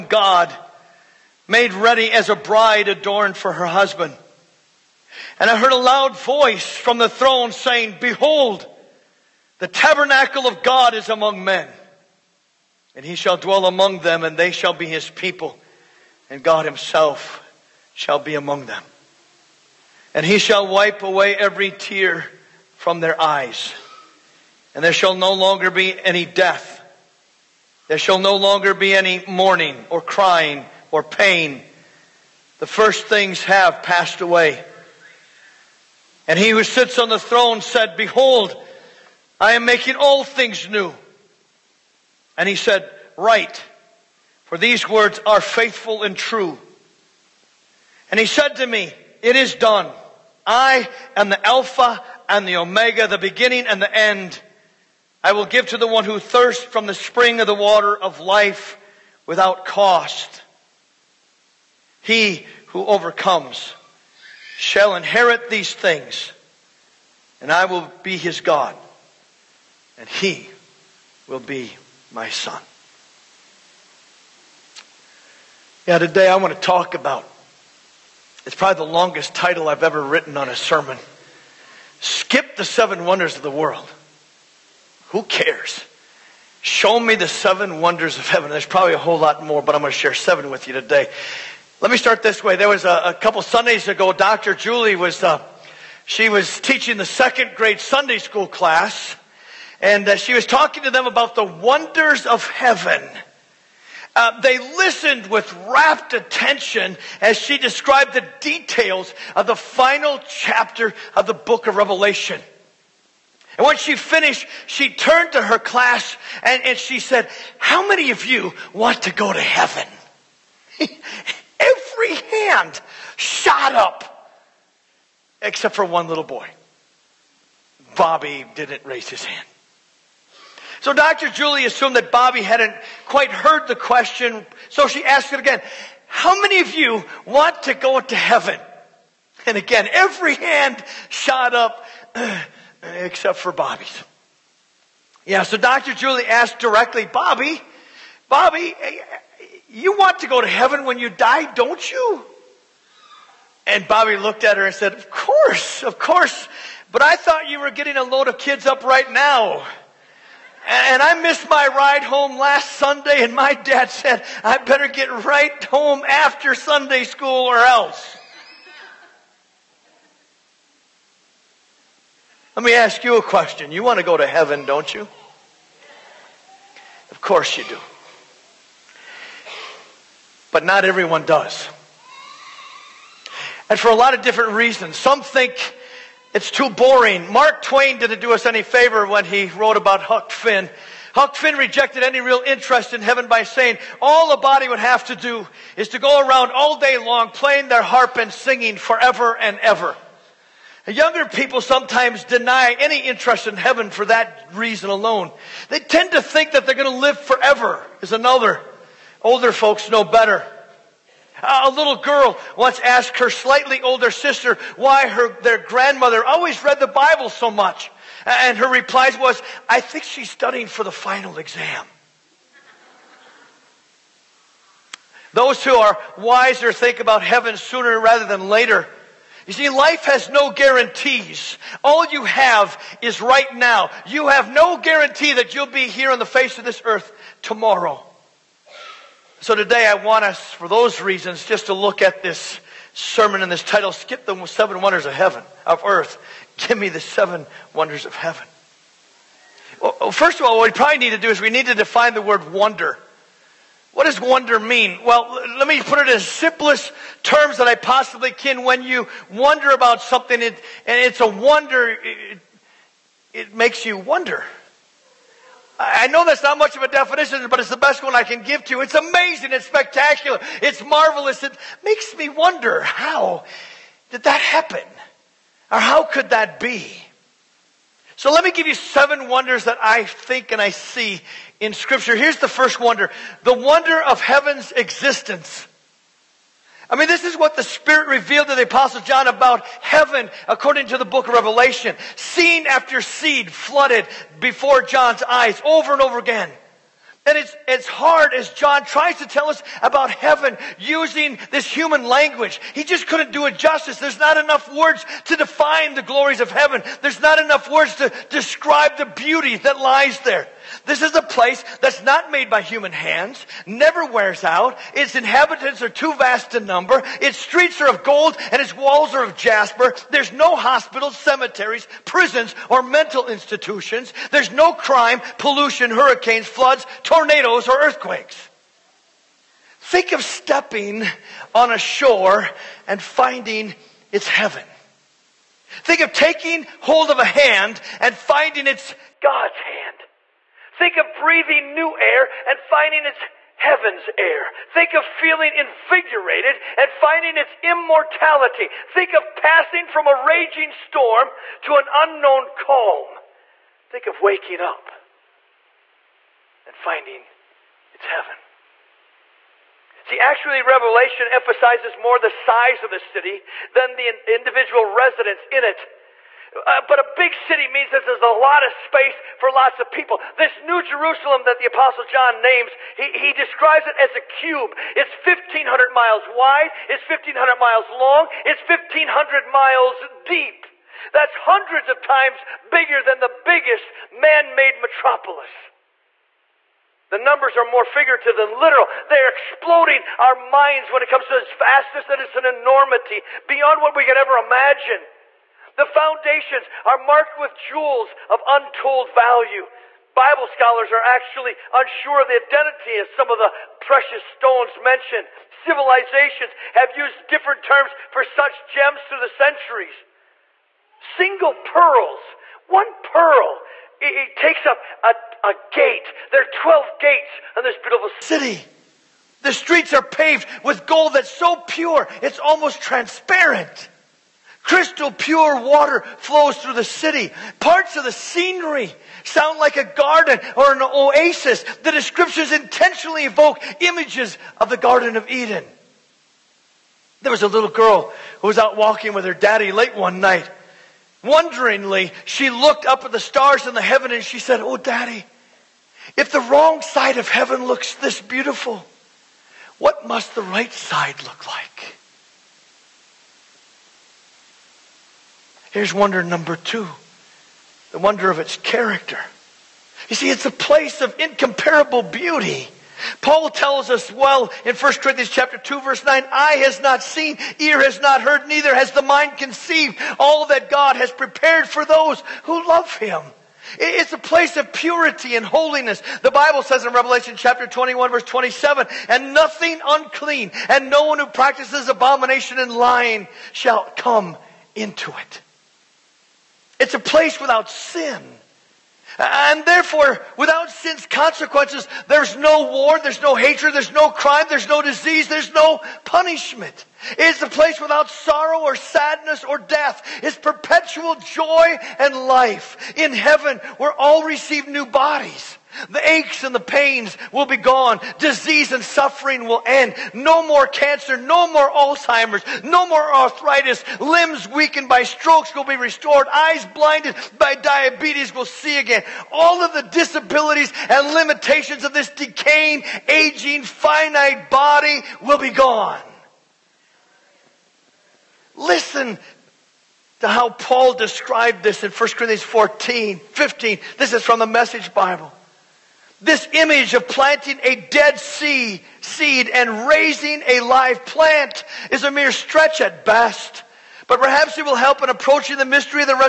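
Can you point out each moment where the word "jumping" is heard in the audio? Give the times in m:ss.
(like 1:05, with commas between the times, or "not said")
not said.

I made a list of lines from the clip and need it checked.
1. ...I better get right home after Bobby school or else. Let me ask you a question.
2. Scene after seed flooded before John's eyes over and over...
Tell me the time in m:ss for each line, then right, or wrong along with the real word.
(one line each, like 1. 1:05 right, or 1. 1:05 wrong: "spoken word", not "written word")
1. 2:44 wrong: "Sunday", not "Bobby"
2. 4:52 right.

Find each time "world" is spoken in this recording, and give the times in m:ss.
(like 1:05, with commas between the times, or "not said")
1:23.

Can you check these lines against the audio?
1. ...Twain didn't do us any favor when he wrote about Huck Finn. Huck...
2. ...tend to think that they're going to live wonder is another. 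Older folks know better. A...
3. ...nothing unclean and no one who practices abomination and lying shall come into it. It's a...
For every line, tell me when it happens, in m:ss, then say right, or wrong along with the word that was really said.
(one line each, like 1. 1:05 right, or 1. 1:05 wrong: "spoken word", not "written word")
1. 3:07 right
2. 3:25 wrong: "forever", not "wonder"
3. 7:59 right.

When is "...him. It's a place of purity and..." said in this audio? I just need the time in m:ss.
7:52.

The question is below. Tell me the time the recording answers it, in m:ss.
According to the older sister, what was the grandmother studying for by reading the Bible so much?
3:40.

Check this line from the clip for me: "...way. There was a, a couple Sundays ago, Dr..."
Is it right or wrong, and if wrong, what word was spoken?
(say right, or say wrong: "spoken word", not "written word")
right.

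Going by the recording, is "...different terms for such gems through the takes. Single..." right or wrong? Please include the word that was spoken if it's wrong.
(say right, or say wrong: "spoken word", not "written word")
wrong: "centuries", not "takes".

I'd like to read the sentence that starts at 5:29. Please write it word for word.
Think of stepping on a shore and finding it's heaven.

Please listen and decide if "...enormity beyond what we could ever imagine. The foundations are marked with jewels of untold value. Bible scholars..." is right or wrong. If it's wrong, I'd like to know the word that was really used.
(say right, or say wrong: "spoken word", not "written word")
right.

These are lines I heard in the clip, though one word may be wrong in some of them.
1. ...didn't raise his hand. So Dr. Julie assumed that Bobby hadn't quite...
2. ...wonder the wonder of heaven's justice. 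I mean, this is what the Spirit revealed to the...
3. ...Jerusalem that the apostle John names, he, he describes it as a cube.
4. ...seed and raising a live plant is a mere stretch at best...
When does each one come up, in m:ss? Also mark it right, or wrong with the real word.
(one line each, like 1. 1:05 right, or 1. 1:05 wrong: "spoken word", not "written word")
1. 2:08 right
2. 4:42 wrong: "existence", not "justice"
3. 6:10 right
4. 8:59 right.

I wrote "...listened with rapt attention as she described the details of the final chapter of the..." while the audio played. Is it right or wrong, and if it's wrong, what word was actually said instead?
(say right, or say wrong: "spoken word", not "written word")
right.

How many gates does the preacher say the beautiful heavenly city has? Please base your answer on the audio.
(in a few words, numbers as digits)
12.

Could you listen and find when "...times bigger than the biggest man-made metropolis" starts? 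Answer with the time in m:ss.
6:22.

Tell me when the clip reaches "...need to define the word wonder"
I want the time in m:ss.
4:11.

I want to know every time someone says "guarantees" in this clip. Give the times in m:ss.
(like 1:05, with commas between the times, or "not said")
3:50, 3:54.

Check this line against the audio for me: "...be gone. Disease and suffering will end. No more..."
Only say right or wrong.
right.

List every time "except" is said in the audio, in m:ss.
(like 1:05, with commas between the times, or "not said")
2:05, 2:22.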